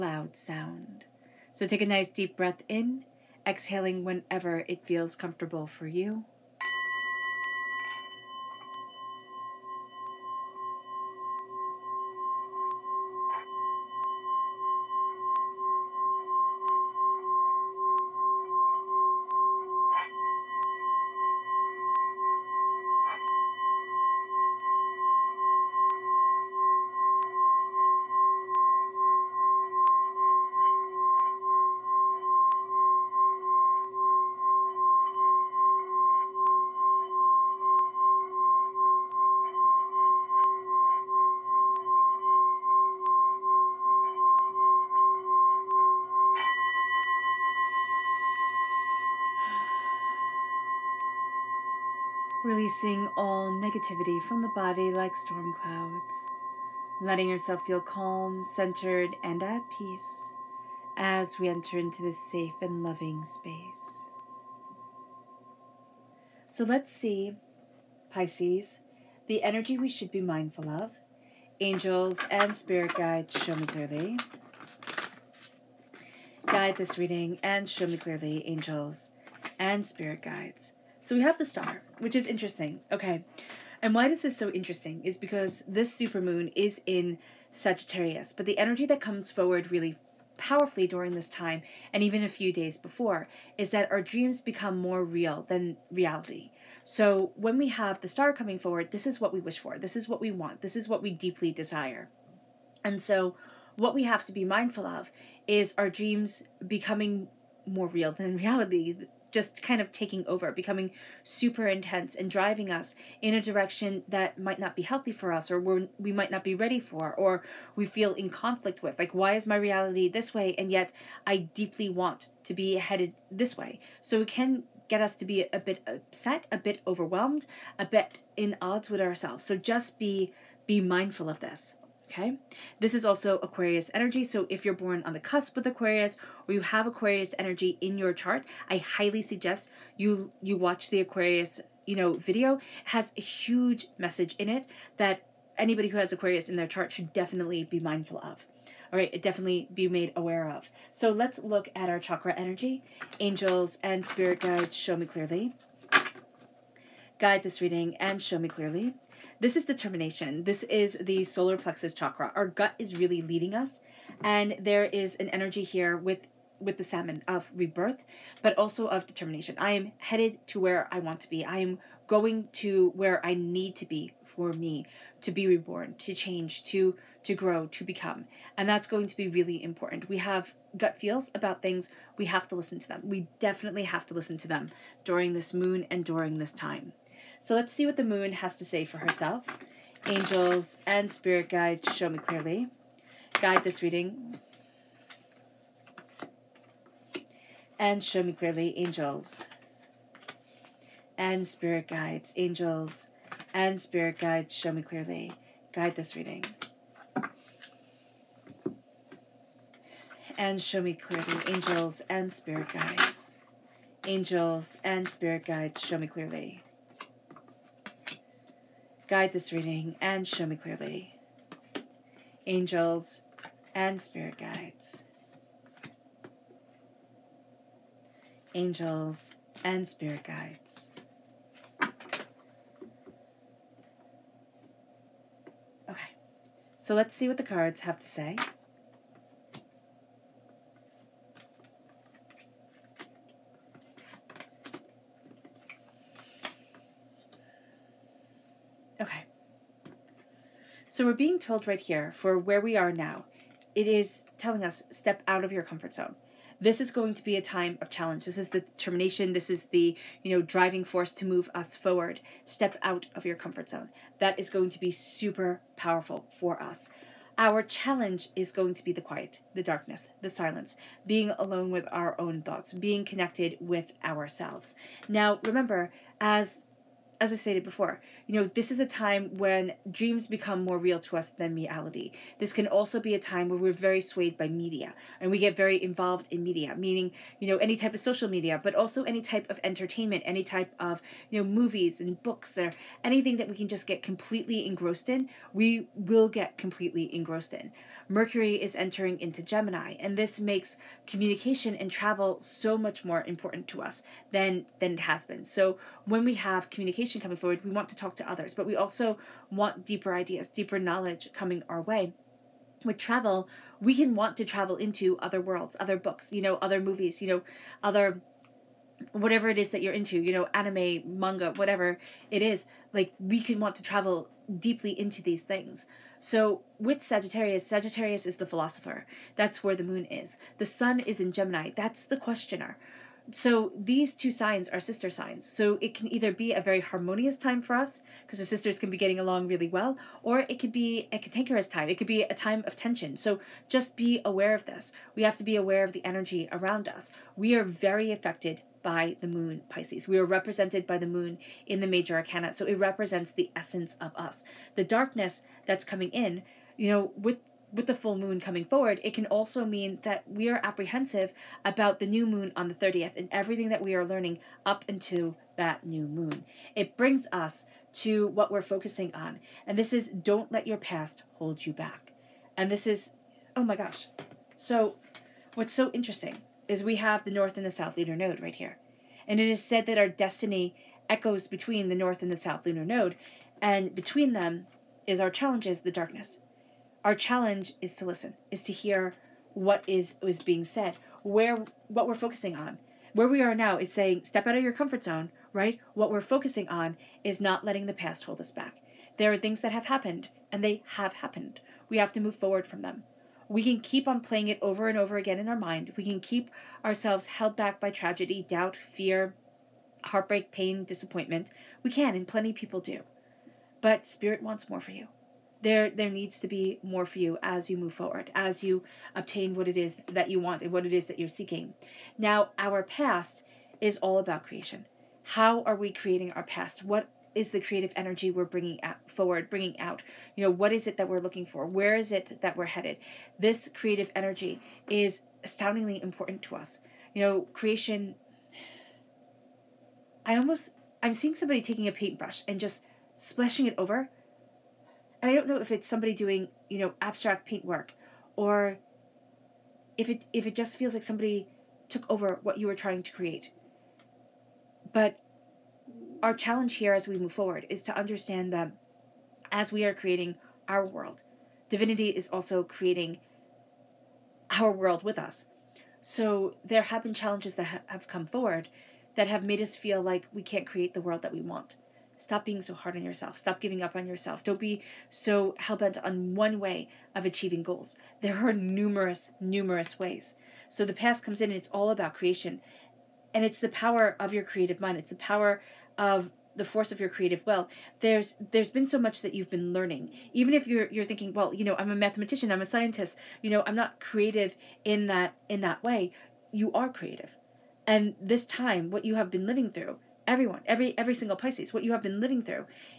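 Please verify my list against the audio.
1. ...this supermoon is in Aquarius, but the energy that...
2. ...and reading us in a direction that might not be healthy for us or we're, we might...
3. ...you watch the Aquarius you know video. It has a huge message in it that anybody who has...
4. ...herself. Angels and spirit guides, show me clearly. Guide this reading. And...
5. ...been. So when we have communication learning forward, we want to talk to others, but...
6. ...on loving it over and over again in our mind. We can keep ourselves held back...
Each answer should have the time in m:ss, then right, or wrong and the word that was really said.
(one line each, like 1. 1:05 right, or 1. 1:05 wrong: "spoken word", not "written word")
1. 1:25 wrong: "Sagittarius", not "Aquarius"
2. 1:52 wrong: "driving", not "reading"
3. 2:20 right
4. 3:08 right
5. 5:05 wrong: "coming", not "learning"
6. 6:44 wrong: "playing", not "loving".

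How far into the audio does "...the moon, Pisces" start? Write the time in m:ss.
5:49.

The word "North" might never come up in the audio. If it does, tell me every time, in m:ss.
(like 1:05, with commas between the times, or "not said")
6:17, 6:21.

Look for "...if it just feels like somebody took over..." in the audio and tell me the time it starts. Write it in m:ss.
7:30.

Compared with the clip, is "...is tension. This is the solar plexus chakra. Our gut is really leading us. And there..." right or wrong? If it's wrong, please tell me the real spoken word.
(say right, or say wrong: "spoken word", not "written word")
wrong: "determination", not "tension".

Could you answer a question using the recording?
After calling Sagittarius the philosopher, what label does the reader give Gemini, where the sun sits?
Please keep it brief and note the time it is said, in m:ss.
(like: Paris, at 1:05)
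The questioner, at 5:32.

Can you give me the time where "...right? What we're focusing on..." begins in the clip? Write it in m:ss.
6:35.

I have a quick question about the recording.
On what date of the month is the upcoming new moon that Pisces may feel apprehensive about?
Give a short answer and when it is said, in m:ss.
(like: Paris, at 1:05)
30th, at 6:02.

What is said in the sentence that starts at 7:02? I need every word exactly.
Now, our past is all about creation.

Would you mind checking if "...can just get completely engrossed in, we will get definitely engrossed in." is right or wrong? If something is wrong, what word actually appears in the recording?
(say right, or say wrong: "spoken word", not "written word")
wrong: "completely", not "definitely".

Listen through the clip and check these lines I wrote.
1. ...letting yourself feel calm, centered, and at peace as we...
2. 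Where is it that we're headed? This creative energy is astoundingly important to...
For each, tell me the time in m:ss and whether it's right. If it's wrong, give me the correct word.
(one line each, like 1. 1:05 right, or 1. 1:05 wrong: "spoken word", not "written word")
1. 0:56 right
2. 7:11 right.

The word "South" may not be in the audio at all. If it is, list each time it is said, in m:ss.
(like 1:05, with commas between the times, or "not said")
6:17, 6:22.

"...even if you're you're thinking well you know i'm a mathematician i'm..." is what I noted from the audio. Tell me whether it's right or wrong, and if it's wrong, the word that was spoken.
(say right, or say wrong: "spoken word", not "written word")
right.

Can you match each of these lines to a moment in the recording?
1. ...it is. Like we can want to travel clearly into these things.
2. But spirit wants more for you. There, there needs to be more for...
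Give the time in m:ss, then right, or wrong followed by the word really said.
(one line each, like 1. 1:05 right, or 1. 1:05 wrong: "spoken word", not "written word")
1. 5:22 wrong: "deeply", not "clearly"
2. 6:53 right.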